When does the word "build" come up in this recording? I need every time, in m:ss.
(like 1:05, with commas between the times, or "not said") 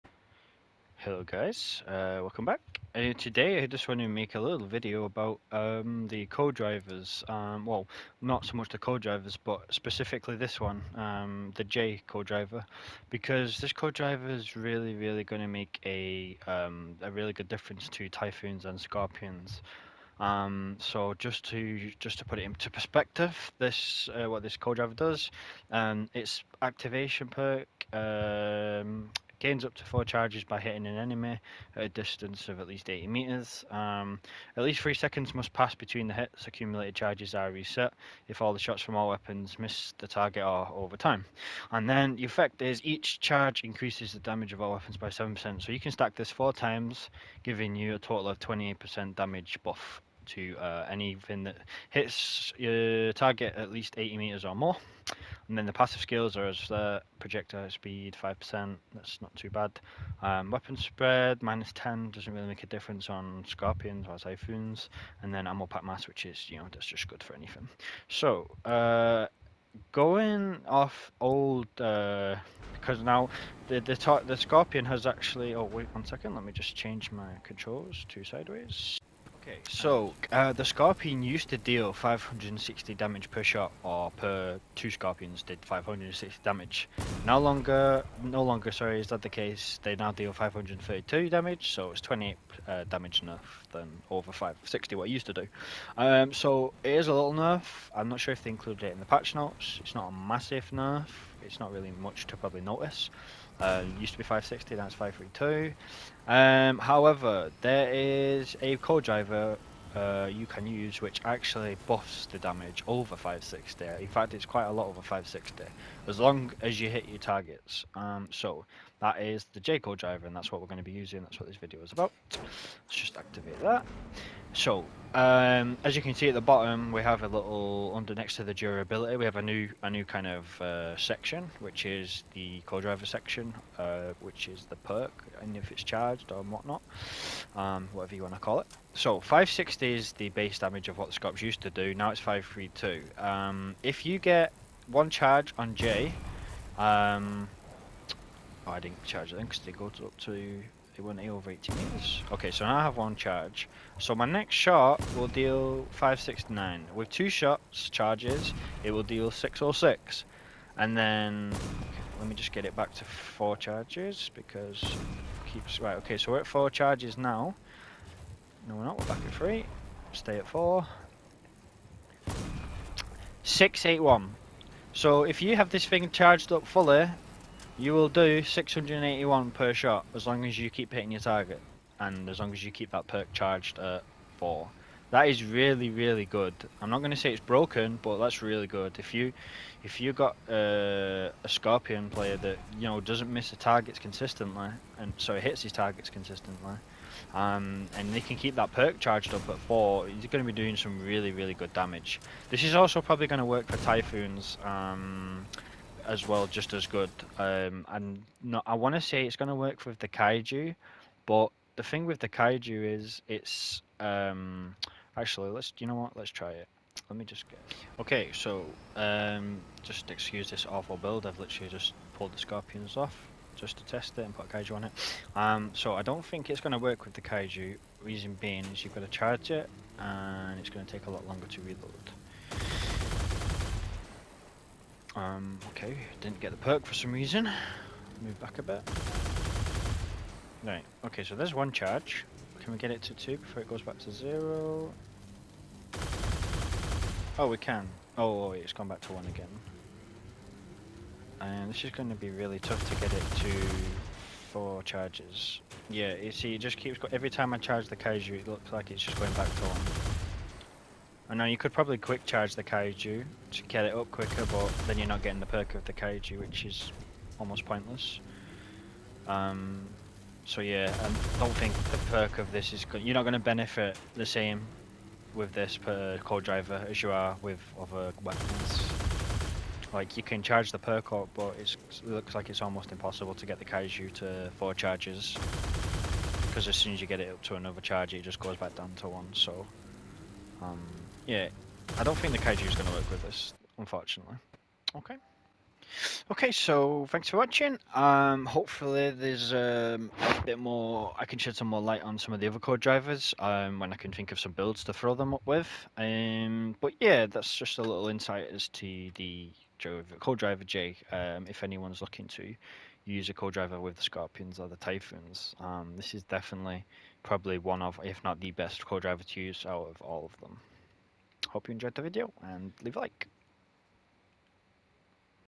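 3:40, 5:04.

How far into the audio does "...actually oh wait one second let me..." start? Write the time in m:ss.
1:15.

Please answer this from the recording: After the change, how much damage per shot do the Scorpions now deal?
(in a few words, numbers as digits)
532.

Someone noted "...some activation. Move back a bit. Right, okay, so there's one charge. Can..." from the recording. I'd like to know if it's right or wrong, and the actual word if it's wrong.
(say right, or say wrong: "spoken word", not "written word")
wrong: "reason", not "activation".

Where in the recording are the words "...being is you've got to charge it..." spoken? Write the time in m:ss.
3:48.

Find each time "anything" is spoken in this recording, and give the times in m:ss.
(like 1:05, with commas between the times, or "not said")
0:50, 1:07.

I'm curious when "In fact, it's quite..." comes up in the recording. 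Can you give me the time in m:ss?
1:53.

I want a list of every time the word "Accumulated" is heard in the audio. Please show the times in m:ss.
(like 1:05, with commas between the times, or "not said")
0:36.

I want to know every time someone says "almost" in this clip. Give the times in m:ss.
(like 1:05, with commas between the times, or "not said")
4:27, 4:42.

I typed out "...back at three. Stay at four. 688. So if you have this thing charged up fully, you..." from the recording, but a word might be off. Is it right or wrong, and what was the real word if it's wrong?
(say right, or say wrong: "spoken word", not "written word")
wrong: "681", not "688".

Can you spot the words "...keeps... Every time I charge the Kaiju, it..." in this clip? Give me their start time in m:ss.
4:16.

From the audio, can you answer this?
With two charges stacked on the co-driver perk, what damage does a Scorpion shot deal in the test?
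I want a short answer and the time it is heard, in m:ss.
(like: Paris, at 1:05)
606, at 2:39.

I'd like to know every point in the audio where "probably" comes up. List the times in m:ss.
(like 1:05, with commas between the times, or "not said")
1:42, 3:23, 4:21, 5:17.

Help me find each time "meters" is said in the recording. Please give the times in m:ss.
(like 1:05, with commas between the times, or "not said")
0:33, 0:54, 2:31.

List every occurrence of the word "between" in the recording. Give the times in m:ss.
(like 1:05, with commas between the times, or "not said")
0:35.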